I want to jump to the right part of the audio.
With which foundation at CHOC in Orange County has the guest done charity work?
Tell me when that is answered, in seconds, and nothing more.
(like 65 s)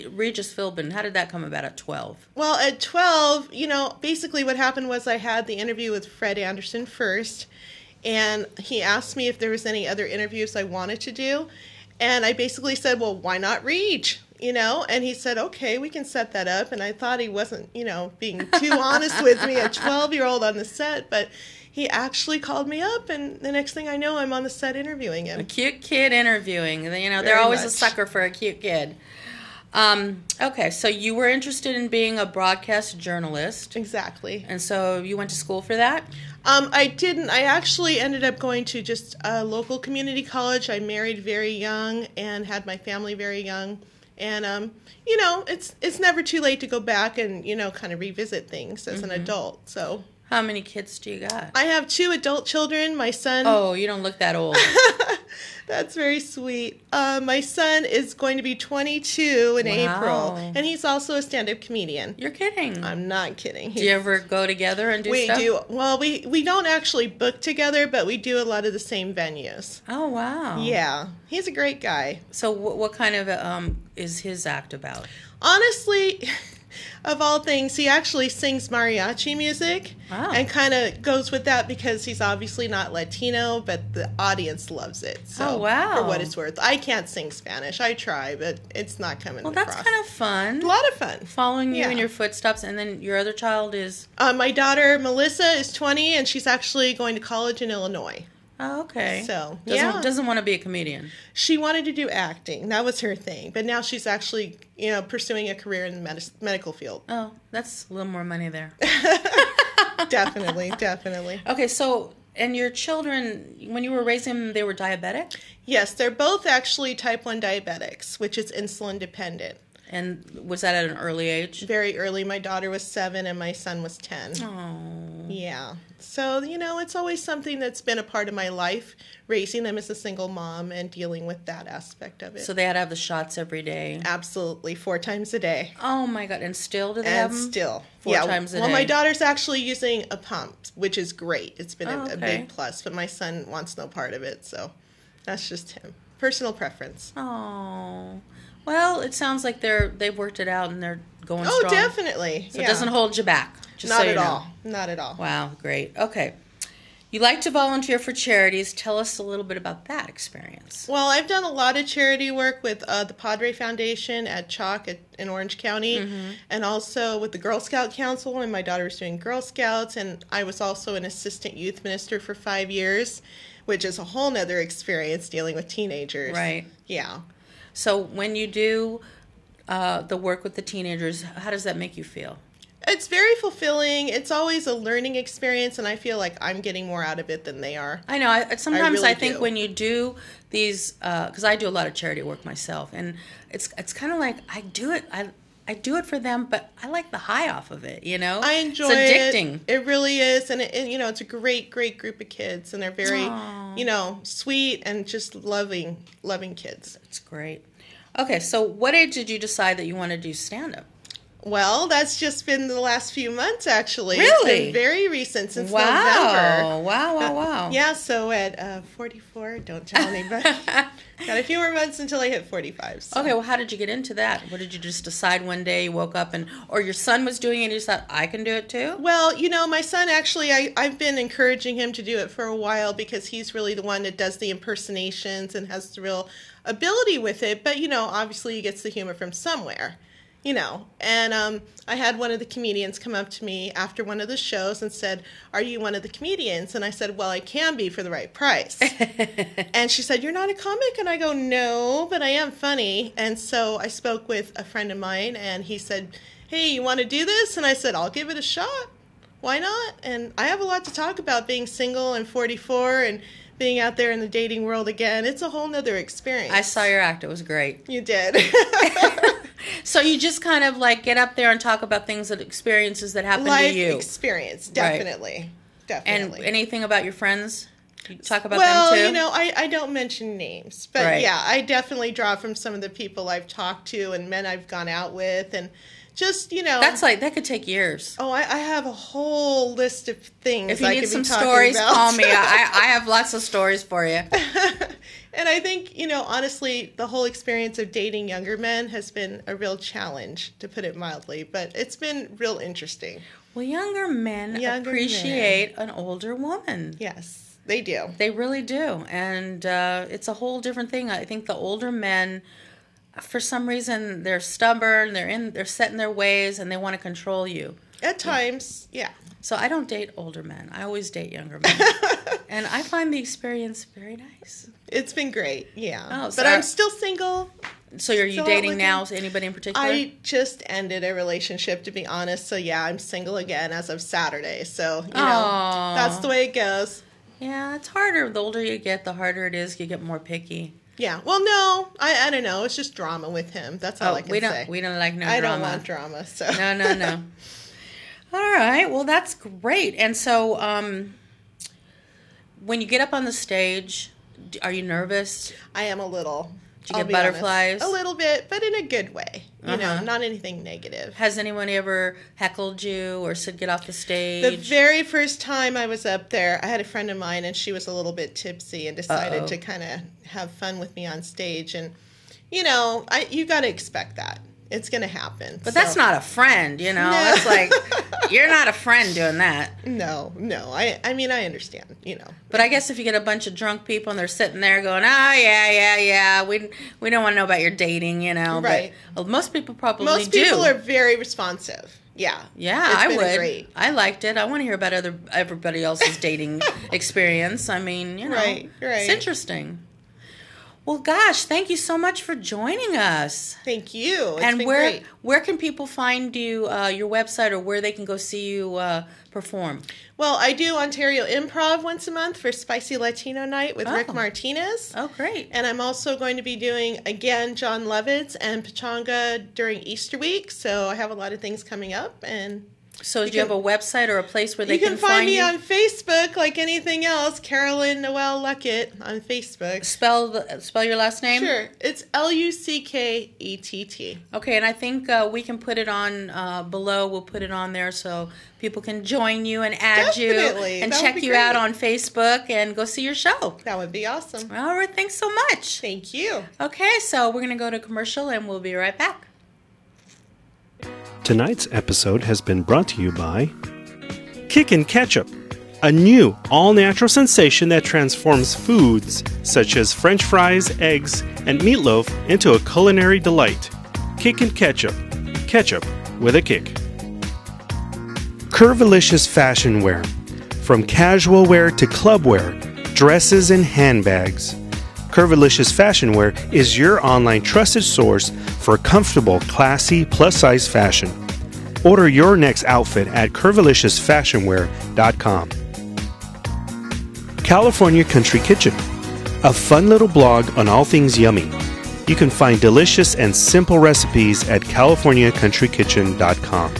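163 s.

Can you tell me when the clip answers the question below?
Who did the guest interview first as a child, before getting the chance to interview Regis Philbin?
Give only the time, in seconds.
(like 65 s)
6 s.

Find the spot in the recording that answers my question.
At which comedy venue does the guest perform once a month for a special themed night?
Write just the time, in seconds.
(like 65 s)
410 s.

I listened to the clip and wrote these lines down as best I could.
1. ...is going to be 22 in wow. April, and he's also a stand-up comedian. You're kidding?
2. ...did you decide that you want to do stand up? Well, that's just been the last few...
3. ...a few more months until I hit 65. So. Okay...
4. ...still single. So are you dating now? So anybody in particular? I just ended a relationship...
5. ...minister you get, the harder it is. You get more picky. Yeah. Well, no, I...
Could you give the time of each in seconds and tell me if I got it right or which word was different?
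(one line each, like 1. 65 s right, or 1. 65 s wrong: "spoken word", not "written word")
1. 57 s right
2. 209 s right
3. 221 s wrong: "45", not "65"
4. 326 s right
5. 338 s wrong: "older", not "minister".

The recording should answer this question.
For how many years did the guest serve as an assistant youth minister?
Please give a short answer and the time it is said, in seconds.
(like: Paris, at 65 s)
5, at 172 s.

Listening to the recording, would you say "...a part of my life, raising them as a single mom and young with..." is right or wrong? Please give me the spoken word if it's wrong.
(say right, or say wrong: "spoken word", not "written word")
wrong: "dealing", not "young".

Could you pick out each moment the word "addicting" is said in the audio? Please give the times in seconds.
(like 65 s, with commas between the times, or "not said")
199 s.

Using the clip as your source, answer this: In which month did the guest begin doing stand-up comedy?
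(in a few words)
November.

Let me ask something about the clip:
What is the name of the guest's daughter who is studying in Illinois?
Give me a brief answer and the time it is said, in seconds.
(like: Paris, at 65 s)
Melissa, at 94 s.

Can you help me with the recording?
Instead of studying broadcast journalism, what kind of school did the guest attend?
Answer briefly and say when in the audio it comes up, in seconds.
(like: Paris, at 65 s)
local community college, at 39 s.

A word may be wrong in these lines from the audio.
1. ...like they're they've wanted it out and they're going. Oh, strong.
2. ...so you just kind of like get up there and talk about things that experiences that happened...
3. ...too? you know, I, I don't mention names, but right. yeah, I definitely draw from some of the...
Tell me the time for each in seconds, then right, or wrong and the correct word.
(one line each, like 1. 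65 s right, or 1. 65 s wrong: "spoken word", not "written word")
1. 149 s wrong: "worked", not "wanted"
2. 269 s right
3. 278 s right.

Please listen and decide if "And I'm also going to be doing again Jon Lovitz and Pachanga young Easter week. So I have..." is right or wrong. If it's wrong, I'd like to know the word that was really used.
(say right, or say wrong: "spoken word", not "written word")
wrong: "during", not "young".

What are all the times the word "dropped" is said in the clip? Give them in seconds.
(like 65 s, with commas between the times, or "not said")
not said.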